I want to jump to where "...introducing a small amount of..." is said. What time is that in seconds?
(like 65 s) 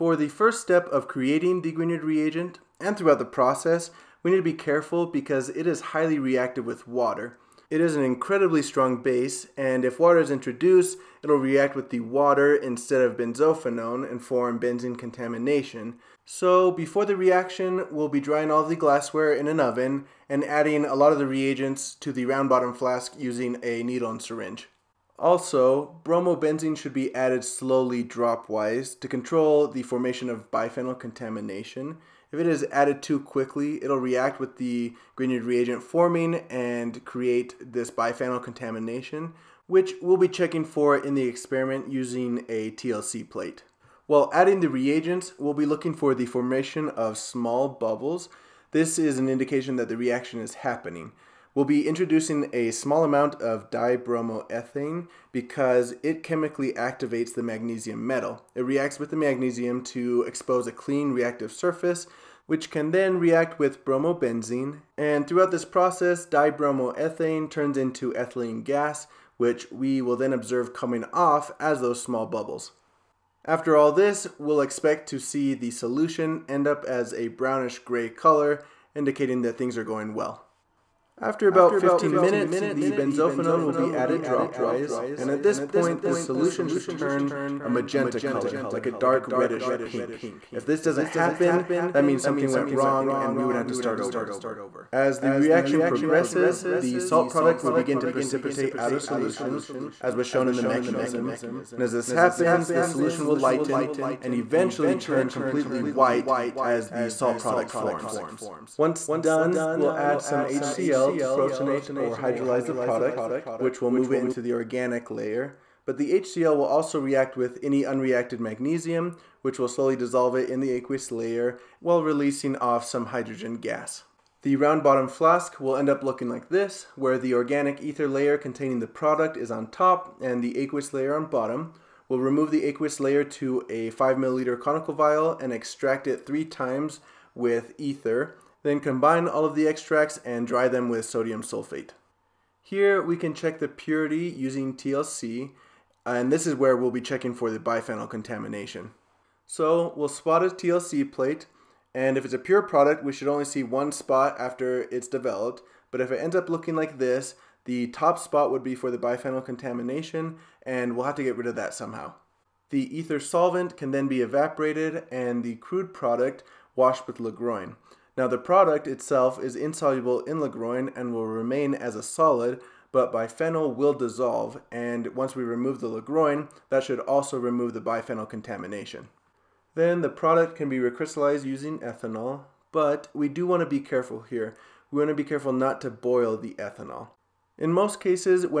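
51 s.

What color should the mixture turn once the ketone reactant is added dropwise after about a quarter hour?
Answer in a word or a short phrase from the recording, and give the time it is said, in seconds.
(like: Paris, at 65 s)
magenta, at 87 s.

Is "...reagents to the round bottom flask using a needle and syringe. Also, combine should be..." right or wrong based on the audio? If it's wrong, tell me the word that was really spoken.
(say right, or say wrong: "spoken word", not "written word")
wrong: "bromobenzene", not "combine".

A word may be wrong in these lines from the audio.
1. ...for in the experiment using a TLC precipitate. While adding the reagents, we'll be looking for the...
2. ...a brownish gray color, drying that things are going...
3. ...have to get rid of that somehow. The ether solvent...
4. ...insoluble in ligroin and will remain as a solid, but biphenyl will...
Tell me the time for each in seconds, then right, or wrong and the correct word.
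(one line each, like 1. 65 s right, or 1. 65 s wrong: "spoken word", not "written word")
1. 40 s wrong: "plate", not "precipitate"
2. 77 s wrong: "indicating", not "drying"
3. 161 s right
4. 169 s right.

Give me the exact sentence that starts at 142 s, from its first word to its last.
Here we can check the purity using TLC and this is where we'll be checking for the biphenyl contamination.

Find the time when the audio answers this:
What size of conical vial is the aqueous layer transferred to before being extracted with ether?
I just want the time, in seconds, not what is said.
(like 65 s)
133 s.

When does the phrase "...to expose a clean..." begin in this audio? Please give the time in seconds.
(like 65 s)
59 s.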